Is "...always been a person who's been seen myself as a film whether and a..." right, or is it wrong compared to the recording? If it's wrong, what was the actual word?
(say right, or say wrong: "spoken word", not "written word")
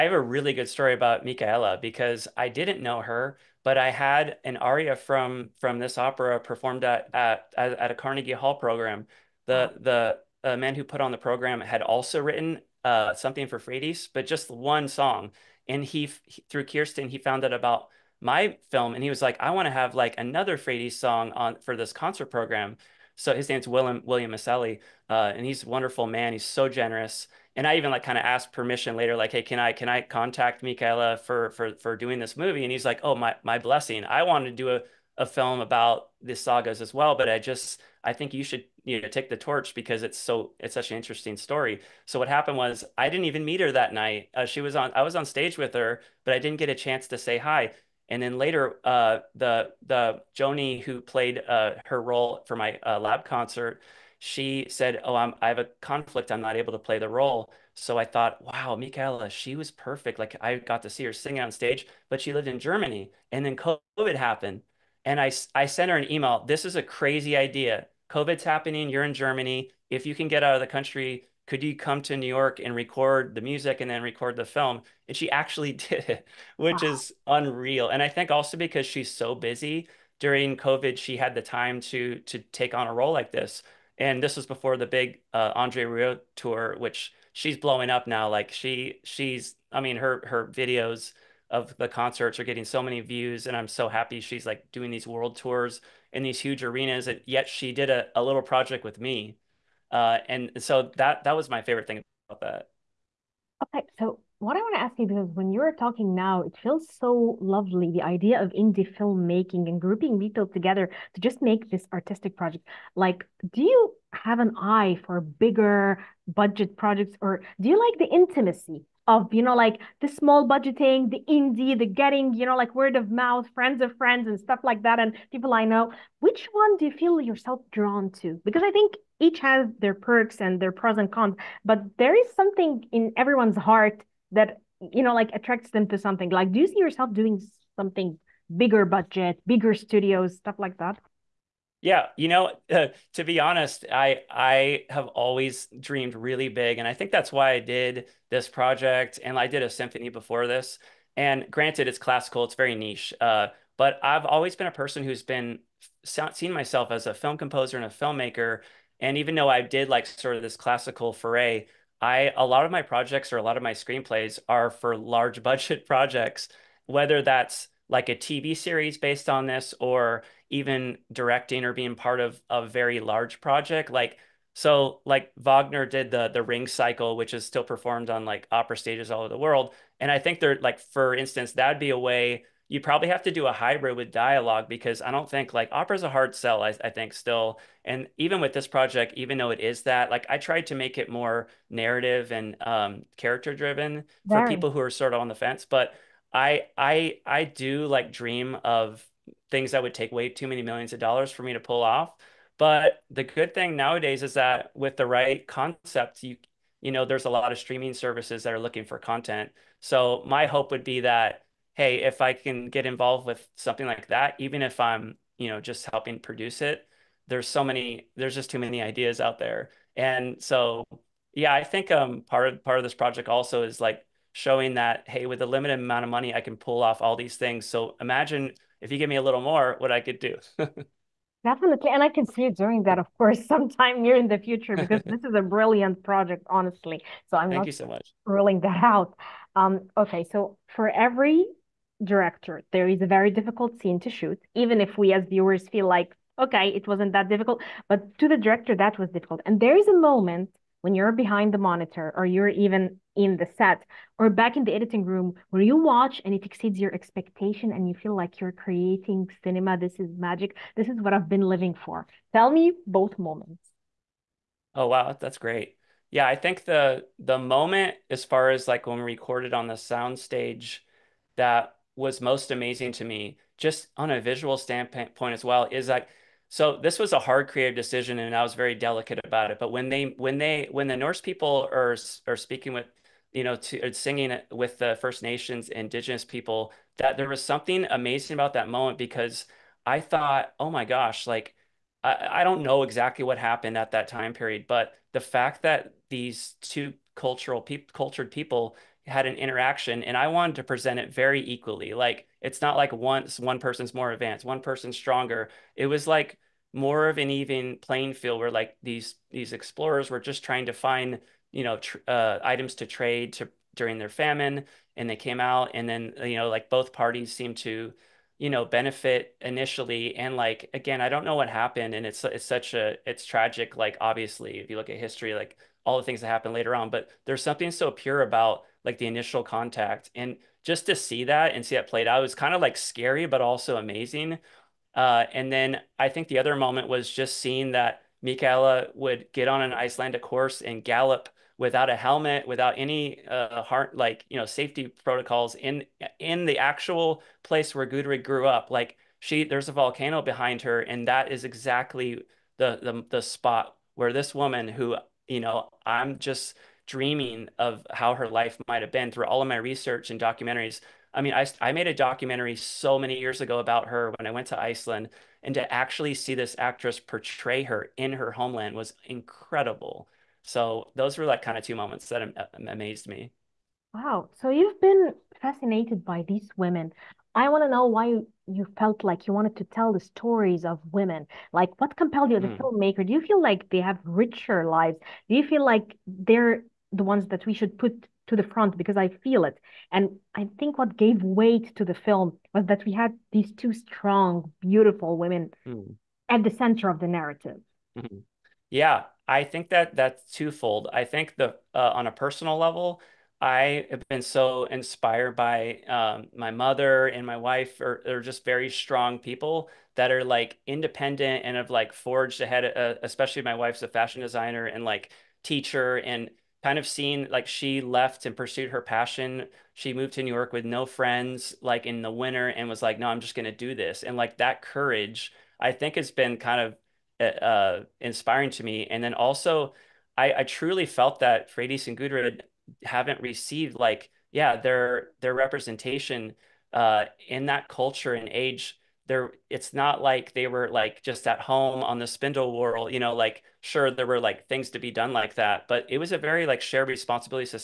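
wrong: "composer", not "whether".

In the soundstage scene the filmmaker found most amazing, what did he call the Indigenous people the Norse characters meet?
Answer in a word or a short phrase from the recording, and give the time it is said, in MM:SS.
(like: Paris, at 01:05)
First Nations, at 04:44.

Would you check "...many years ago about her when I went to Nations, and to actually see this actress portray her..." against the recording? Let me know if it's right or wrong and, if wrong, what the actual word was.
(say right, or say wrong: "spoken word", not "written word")
wrong: "Iceland", not "Nations".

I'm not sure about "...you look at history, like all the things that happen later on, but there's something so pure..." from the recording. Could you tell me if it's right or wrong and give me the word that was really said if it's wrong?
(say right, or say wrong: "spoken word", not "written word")
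right.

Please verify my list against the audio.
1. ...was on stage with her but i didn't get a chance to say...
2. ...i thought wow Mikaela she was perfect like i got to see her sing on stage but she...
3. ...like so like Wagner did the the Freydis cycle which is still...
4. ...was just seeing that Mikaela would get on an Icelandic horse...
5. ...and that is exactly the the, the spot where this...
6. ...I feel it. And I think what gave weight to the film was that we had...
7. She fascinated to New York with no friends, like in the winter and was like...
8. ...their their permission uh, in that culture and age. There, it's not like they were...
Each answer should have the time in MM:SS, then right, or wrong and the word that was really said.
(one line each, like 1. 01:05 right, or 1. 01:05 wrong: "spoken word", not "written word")
1. 00:45 right
2. 00:57 right
3. 02:53 wrong: "Ring", not "Freydis"
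4. 05:36 right
5. 05:50 right
6. 06:28 right
7. 06:59 wrong: "moved", not "fascinated"
8. 07:14 wrong: "representation", not "permission".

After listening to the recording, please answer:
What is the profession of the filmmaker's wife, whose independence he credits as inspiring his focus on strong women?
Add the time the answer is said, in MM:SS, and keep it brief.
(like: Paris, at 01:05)
Fashion designer, at 06:53.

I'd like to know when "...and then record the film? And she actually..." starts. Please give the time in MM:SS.
01:13.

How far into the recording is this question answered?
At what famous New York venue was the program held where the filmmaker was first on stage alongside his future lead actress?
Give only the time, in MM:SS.
00:07.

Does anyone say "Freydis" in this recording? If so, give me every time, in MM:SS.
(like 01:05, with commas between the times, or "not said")
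00:13, 00:20, 07:11.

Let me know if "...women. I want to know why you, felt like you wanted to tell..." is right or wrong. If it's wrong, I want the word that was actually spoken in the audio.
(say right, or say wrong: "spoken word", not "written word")
right.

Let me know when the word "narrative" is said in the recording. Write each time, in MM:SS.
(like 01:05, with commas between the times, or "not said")
03:11, 06:37.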